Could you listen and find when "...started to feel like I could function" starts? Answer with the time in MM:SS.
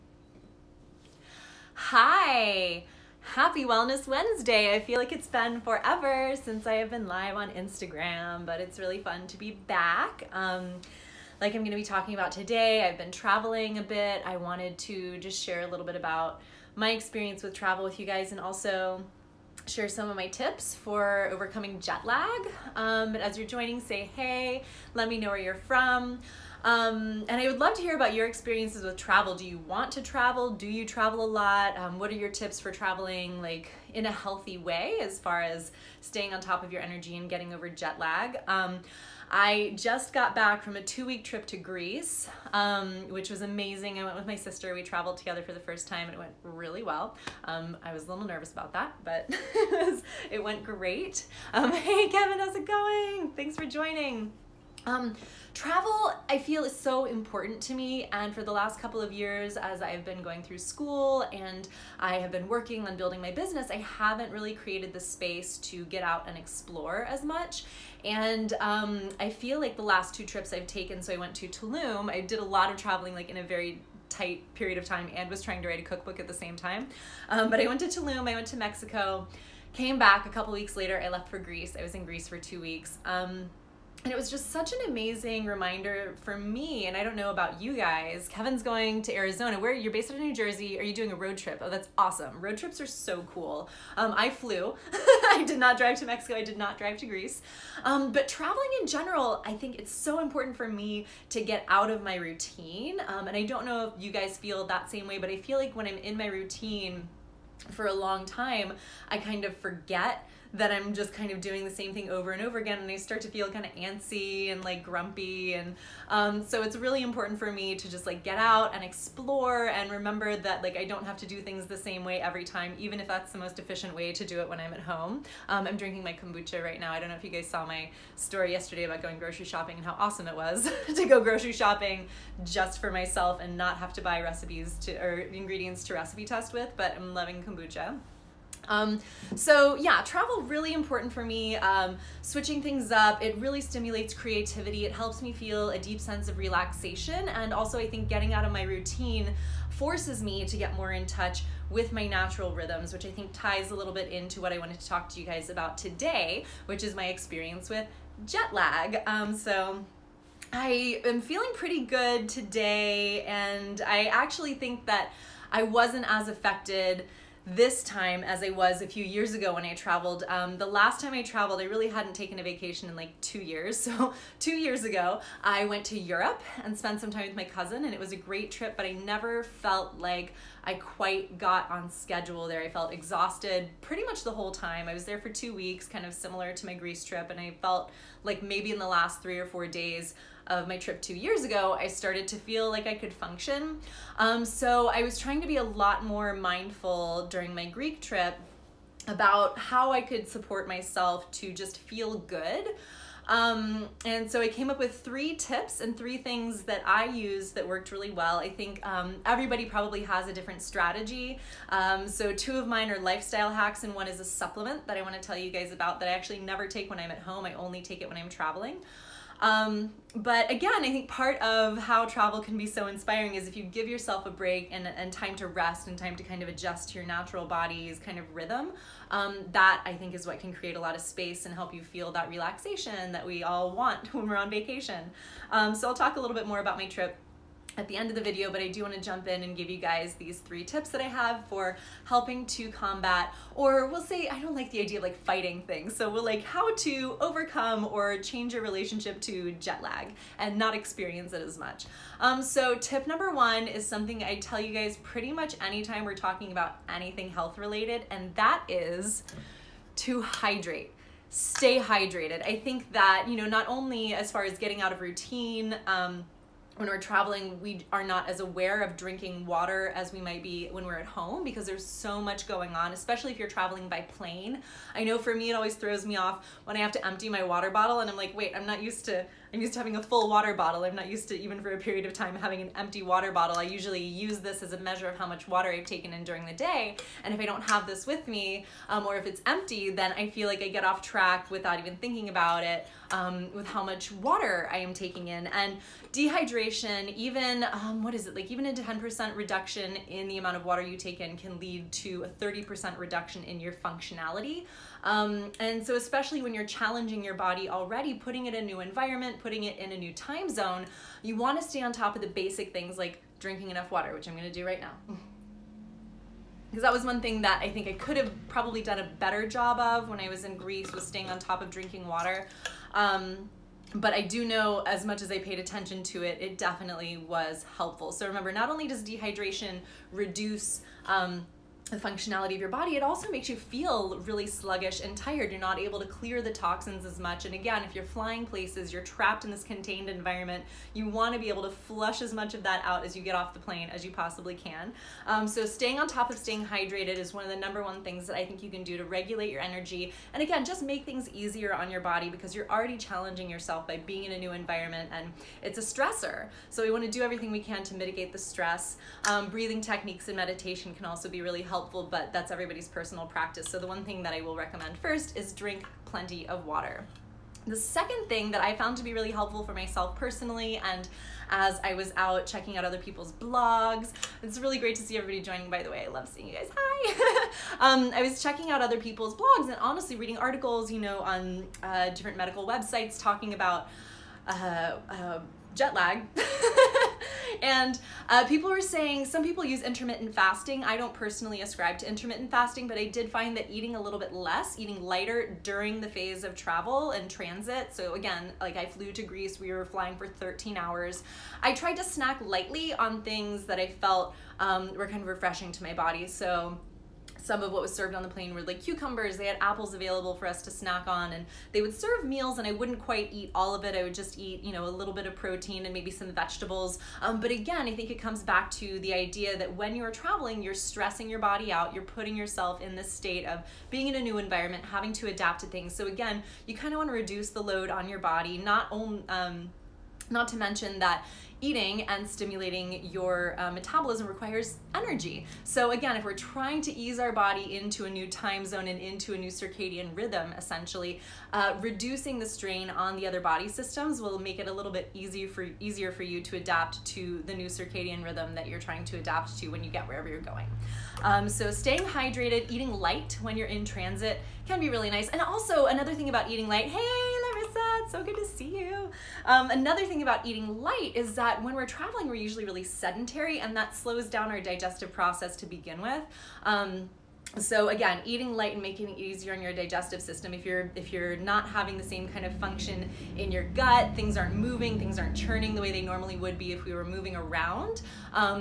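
03:11.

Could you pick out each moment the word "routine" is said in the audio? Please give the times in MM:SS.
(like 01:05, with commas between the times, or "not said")
01:42, 01:46, 02:28, 04:25.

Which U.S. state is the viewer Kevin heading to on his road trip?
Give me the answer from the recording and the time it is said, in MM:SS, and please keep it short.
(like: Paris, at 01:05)
Arizona, at 01:29.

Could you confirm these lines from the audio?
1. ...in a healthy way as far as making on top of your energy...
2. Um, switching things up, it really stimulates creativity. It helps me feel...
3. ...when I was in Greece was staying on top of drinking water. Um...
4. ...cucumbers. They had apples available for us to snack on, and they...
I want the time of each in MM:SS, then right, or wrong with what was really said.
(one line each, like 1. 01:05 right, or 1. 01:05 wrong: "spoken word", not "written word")
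1. 00:33 wrong: "staying", not "making"
2. 02:21 right
3. 05:20 right
4. 06:48 right.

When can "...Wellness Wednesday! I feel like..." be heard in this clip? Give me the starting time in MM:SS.
00:03.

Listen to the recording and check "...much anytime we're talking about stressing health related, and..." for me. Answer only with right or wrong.
wrong.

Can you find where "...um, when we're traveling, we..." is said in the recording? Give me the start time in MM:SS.
04:25.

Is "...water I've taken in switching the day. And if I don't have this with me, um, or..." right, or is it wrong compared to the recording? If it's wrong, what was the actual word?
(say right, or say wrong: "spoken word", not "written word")
wrong: "during", not "switching".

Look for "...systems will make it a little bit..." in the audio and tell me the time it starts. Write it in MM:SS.
07:23.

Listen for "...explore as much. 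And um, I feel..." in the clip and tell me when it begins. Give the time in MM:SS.
01:06.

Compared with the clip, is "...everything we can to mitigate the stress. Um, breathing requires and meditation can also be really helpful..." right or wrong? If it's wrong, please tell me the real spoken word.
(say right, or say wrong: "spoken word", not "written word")
wrong: "techniques", not "requires".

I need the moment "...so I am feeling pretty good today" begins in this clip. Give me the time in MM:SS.
02:39.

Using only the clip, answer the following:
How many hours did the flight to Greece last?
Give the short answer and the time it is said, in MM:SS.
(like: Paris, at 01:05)
13, at 06:40.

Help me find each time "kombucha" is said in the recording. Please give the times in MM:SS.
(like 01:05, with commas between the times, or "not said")
02:06, 02:17.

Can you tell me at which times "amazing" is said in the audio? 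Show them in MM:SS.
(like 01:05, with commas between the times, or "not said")
00:43, 01:24.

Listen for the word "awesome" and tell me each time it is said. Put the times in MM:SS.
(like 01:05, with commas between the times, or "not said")
01:31, 02:09.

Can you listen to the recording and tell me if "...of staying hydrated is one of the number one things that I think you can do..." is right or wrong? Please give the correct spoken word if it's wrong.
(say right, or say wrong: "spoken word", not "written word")
right.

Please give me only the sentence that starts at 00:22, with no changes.
Um, but as you're joining, say hey, let me know where you're from.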